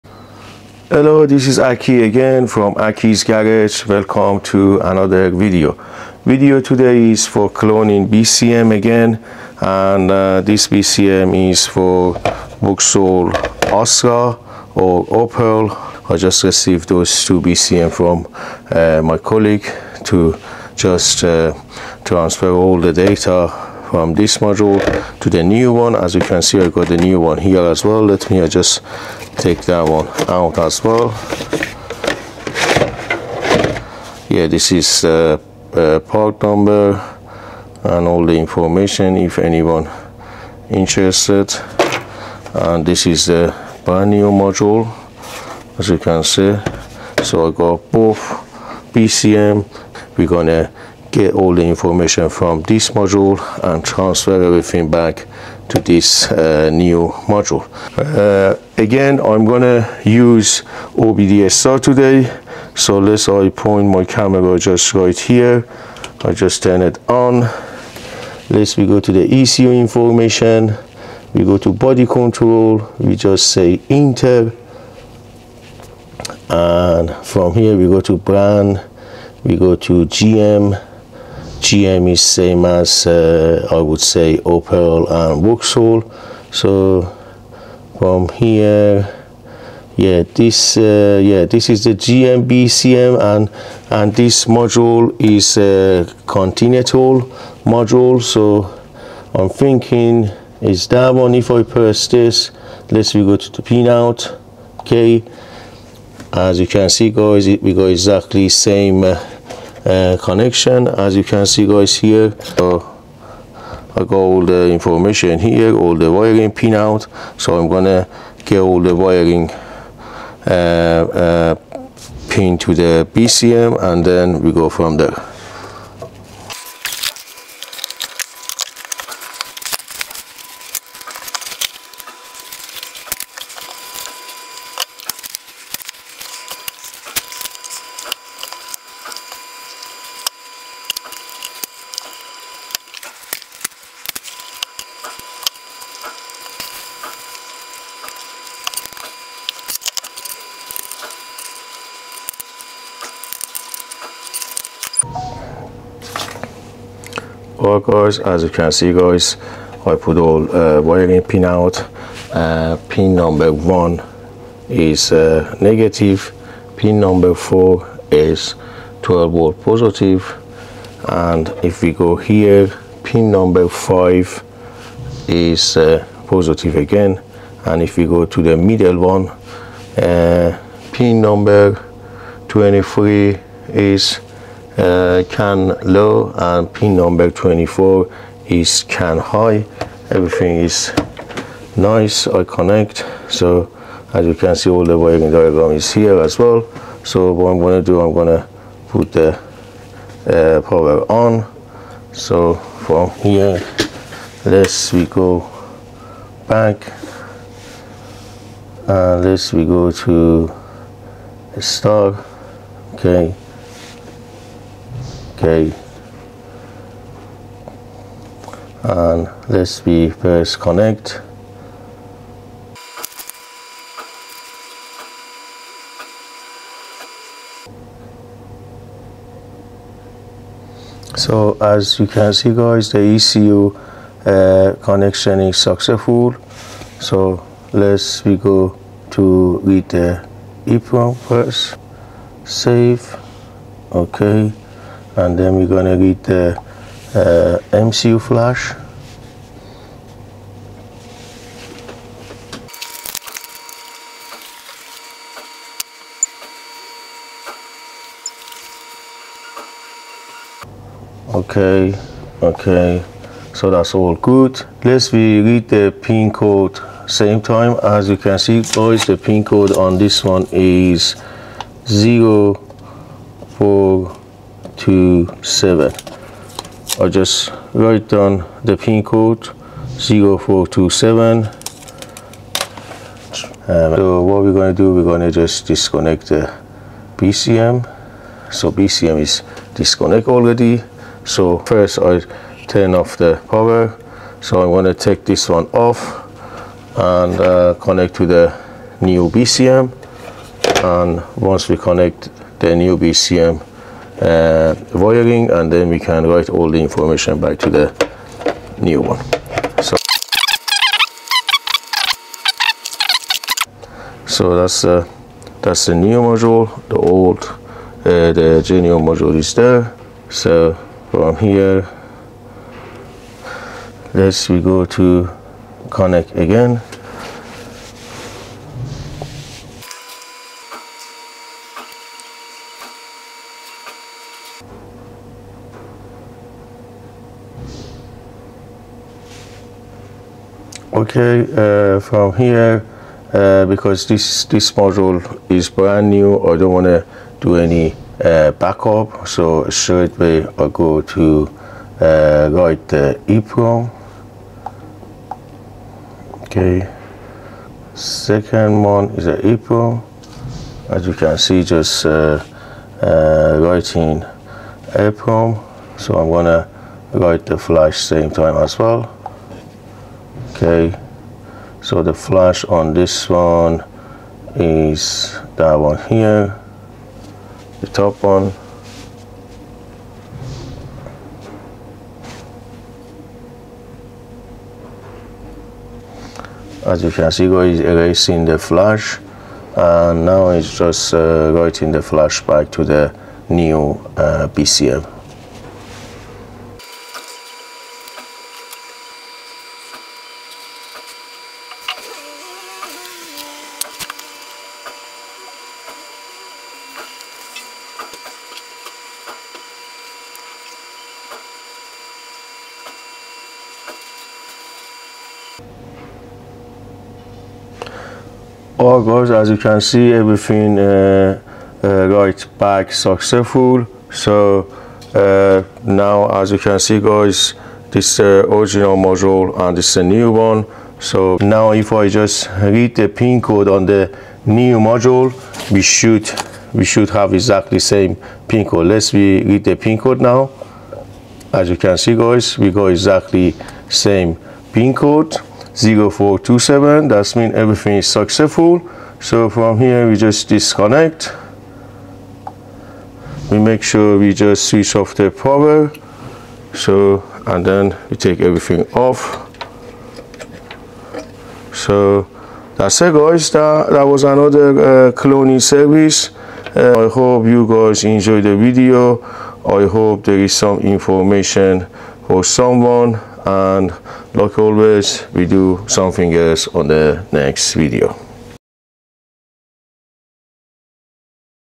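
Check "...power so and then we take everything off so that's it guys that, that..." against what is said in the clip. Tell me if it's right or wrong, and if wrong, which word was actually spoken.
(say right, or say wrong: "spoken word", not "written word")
right.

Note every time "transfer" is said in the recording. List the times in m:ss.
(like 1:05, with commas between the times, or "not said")
0:22, 0:53.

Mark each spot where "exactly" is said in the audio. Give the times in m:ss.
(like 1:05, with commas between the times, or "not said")
1:47, 7:17, 7:22.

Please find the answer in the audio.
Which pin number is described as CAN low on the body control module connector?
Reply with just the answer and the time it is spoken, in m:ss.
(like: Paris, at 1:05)
23, at 3:02.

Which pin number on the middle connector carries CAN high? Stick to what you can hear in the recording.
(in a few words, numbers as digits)
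24.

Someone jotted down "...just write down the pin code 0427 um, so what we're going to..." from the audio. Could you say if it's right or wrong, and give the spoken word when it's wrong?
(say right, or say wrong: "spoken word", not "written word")
right.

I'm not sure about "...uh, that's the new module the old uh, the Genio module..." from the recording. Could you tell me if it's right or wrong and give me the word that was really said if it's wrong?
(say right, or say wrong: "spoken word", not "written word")
right.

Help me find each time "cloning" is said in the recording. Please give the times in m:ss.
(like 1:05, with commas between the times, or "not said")
0:07, 7:45.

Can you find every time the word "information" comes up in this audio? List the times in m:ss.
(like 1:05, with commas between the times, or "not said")
0:38, 0:51, 1:09, 1:54, 5:06, 7:50.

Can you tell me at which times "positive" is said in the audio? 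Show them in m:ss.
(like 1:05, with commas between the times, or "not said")
2:49, 2:56.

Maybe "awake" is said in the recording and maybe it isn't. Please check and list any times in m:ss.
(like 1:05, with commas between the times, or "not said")
not said.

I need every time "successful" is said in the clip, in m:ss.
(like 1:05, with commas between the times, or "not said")
3:55, 7:02, 7:28.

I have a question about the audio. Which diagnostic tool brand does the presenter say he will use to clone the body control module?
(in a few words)
OBDSTAR.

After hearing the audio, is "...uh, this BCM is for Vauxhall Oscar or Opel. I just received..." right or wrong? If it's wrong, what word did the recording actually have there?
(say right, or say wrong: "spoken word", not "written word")
right.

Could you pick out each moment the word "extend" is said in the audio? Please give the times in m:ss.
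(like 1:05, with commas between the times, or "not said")
not said.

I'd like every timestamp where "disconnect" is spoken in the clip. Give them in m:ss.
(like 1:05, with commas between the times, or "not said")
4:45, 4:49, 7:30.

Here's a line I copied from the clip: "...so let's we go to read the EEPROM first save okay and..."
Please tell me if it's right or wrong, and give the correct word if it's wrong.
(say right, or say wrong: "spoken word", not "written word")
right.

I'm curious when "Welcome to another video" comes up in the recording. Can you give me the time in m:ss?
0:03.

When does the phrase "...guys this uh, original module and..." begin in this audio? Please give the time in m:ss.
7:06.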